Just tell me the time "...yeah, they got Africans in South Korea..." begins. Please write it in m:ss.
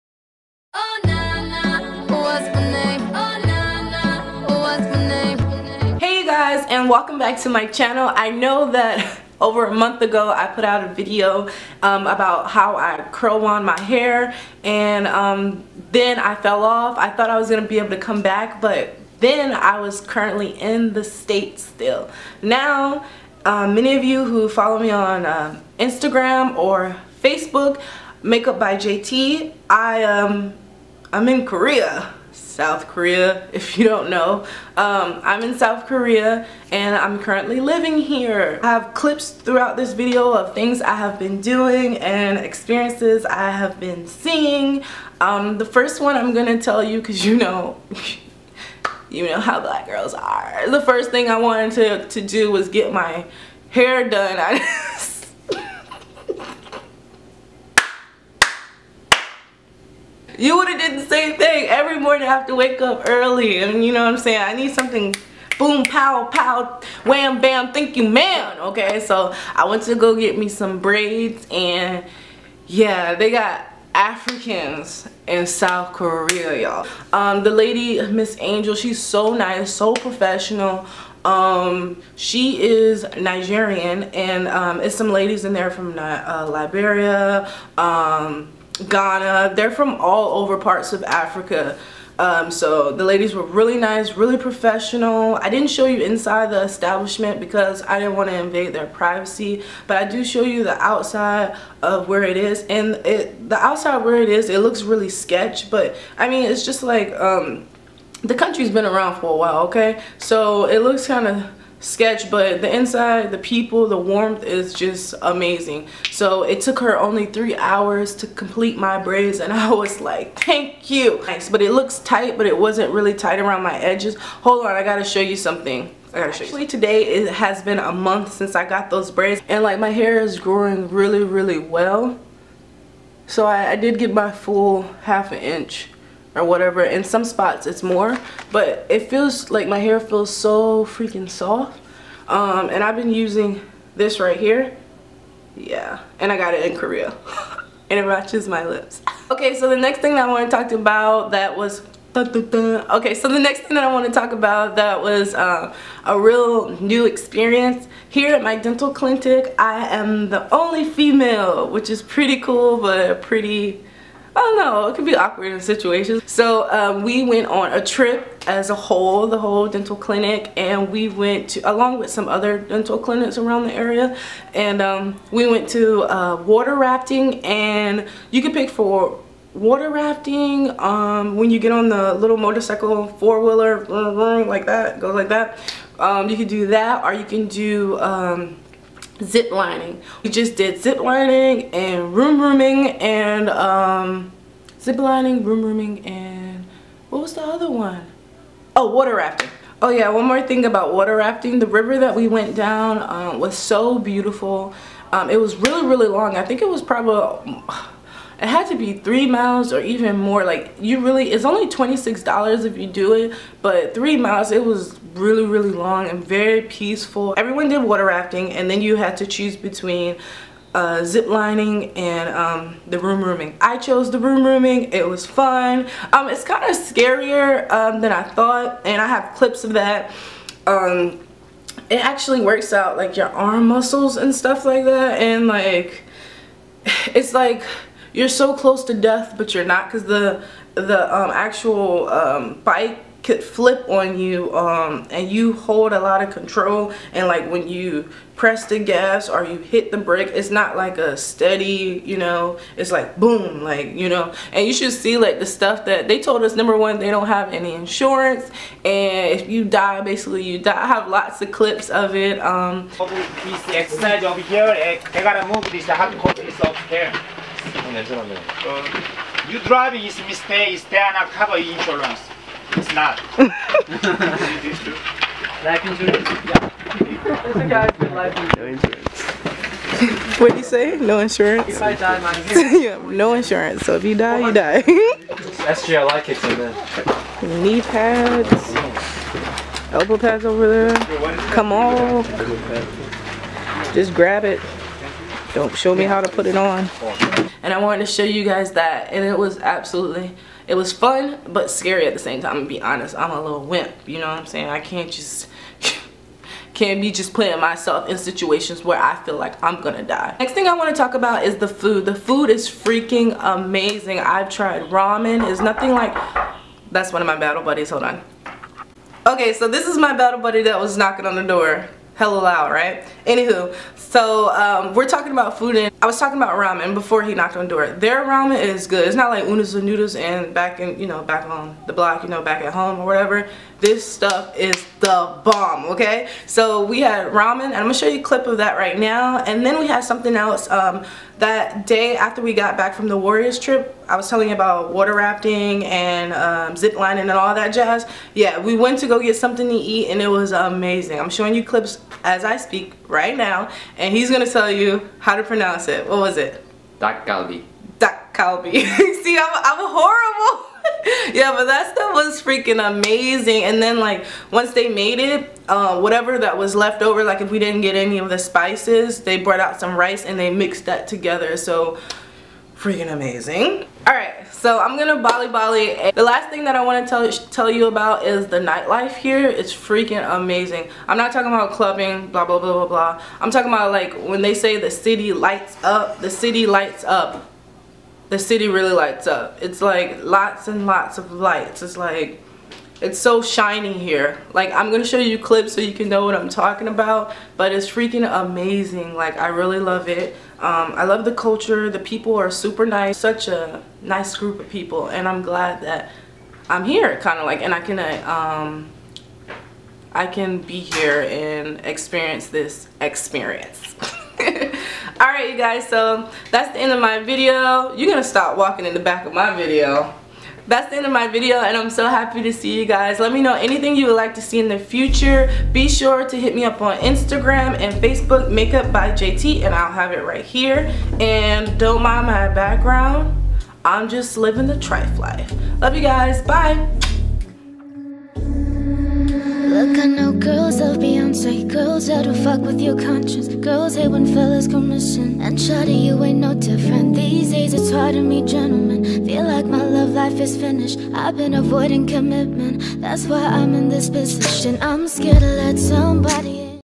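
1:12.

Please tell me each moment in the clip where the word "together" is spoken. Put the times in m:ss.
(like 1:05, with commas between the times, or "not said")
6:11.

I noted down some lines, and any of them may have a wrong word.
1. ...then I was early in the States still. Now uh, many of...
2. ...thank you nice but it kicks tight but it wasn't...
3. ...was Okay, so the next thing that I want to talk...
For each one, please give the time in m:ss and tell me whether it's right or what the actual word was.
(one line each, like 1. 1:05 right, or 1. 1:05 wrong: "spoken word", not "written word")
1. 0:19 wrong: "currently", not "early"
2. 2:00 wrong: "looks", not "kicks"
3. 2:31 right.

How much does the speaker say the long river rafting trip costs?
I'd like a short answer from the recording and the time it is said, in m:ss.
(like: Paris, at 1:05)
$26, at 3:31.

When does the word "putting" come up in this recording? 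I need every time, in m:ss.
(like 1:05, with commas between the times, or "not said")
5:07.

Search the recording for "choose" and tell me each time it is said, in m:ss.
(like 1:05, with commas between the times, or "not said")
3:39.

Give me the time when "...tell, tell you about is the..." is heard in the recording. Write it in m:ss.
6:17.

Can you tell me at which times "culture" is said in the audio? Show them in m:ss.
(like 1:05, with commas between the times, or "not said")
6:41.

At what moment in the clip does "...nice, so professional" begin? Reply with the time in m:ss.
1:19.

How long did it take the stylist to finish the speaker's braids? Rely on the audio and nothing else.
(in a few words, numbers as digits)
3 hours.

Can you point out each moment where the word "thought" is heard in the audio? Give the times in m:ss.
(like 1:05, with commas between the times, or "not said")
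0:17, 3:48.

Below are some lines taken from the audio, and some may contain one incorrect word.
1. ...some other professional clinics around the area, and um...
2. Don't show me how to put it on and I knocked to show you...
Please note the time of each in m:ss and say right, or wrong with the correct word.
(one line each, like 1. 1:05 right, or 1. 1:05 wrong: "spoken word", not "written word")
1. 2:52 wrong: "dental", not "professional"
2. 4:55 wrong: "wanted", not "knocked".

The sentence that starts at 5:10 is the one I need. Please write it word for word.
Next thing I wanna talk about is the food.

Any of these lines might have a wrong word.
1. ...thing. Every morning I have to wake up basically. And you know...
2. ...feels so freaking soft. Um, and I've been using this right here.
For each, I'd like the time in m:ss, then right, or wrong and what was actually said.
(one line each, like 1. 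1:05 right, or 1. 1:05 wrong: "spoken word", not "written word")
1. 1:01 wrong: "early", not "basically"
2. 2:19 right.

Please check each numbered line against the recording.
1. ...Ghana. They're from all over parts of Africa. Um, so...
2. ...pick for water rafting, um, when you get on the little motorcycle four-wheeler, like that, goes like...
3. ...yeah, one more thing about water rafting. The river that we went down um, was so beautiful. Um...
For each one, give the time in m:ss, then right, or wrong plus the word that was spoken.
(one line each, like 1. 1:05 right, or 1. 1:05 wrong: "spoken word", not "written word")
1. 1:28 right
2. 2:58 right
3. 3:19 right.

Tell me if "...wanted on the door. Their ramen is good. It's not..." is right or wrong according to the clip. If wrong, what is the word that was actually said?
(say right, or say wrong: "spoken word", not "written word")
wrong: "knocked", not "wanted".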